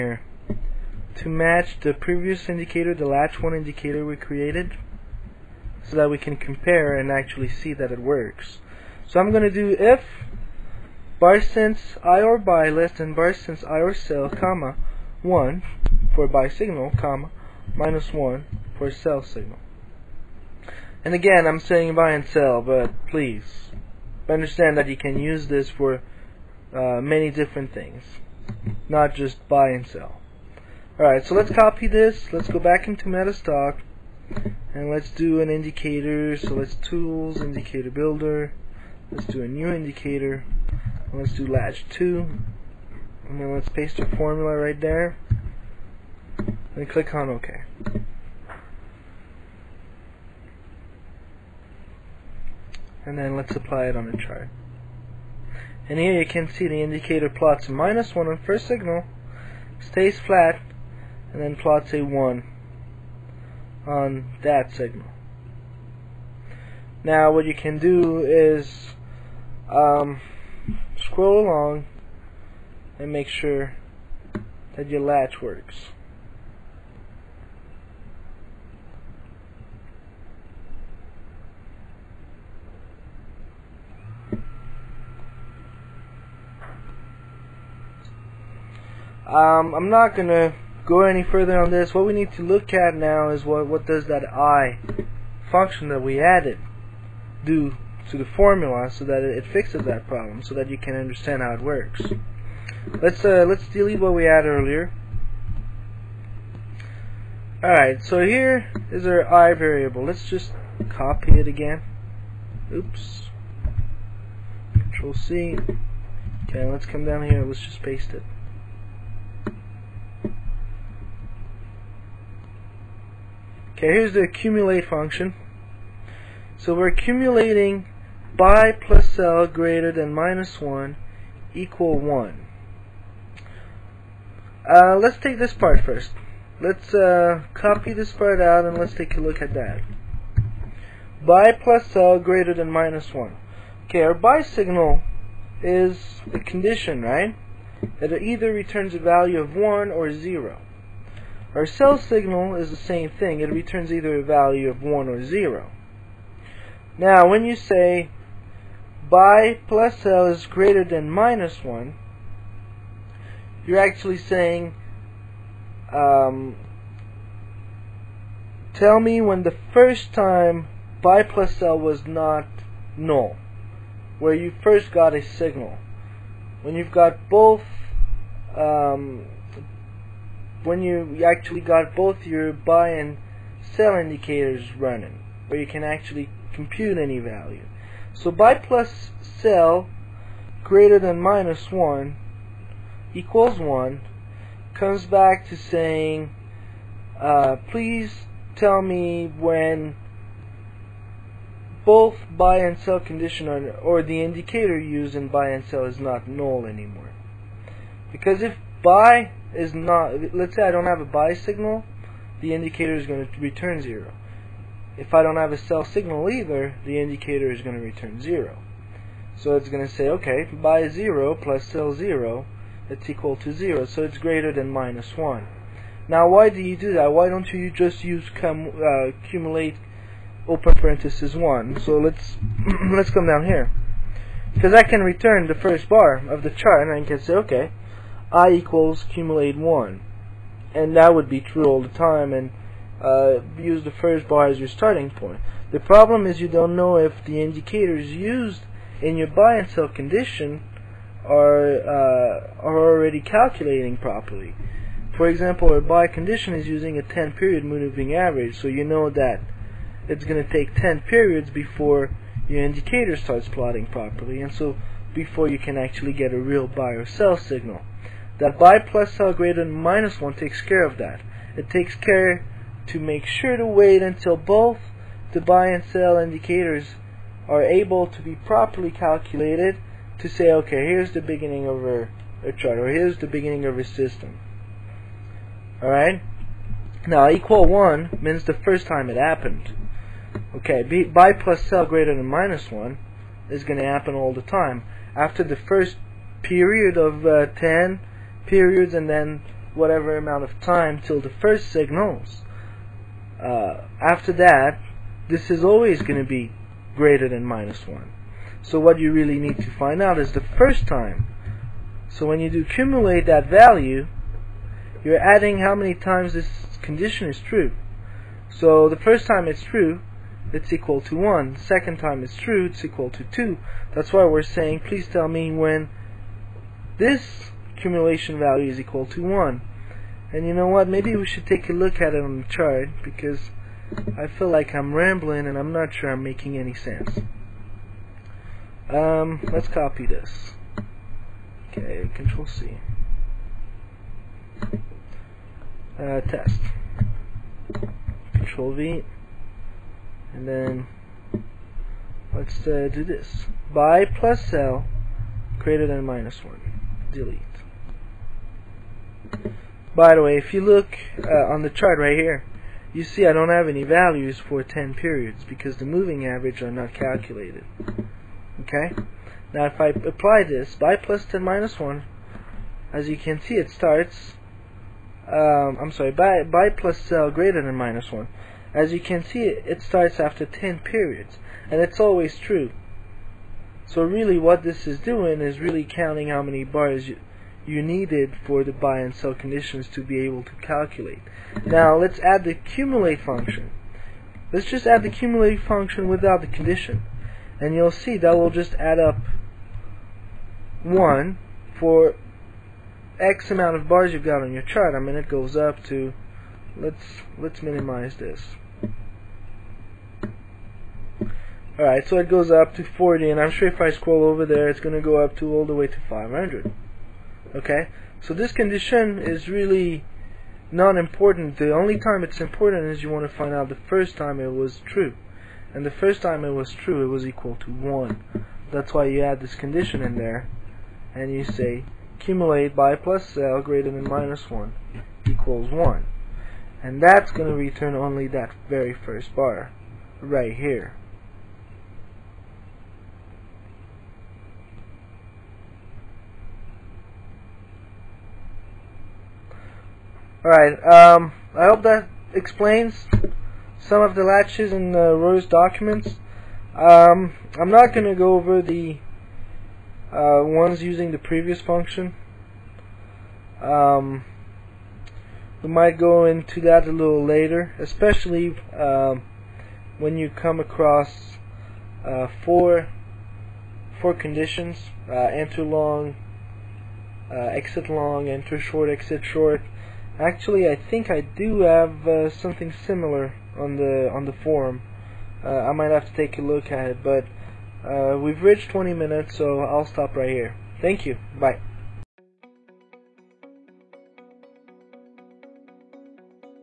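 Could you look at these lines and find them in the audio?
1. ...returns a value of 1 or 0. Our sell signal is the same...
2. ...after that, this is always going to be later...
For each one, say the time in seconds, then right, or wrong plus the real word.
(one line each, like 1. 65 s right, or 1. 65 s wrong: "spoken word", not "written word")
1. 148 s right
2. 304 s wrong: "greater", not "later".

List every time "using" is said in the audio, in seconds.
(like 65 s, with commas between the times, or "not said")
256 s, 460 s.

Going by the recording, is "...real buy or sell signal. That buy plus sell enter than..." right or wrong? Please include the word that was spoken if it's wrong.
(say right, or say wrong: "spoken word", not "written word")
wrong: "greater", not "enter".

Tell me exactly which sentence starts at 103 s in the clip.
Let's uh, let's delete what we had earlier.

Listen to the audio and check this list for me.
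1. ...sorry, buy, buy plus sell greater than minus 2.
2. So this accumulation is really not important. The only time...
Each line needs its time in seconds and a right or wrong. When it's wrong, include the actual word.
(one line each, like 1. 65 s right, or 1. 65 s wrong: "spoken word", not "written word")
1. 375 s wrong: "1", not "2"
2. 418 s wrong: "condition", not "accumulation".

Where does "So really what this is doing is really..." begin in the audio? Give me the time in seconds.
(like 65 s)
383 s.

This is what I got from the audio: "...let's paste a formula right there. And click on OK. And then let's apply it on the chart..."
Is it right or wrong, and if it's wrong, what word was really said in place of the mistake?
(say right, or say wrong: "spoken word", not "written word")
right.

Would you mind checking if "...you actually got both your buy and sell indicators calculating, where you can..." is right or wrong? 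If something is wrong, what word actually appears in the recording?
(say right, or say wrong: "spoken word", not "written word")
wrong: "running", not "calculating".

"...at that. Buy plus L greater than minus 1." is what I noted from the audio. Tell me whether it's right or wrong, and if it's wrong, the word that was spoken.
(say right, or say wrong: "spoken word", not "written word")
right.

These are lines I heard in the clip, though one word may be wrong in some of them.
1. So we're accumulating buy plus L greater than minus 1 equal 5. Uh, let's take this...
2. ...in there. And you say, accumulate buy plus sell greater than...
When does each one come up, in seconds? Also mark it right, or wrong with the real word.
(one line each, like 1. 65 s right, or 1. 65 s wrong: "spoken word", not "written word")
1. 126 s wrong: "1", not "5"
2. 430 s right.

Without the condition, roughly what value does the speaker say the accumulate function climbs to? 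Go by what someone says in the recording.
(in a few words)
40.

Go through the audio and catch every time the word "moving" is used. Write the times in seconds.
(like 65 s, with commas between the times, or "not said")
257 s, 365 s.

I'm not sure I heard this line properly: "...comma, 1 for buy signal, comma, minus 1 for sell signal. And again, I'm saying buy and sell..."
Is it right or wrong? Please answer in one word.
right.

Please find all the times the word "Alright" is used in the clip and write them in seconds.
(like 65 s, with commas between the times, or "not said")
30 s, 107 s, 285 s, 411 s, 450 s.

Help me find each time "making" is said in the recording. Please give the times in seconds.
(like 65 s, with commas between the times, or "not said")
336 s.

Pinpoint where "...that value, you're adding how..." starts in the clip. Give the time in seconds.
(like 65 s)
313 s.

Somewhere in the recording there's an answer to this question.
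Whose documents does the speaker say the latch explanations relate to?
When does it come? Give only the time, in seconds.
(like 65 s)
455 s.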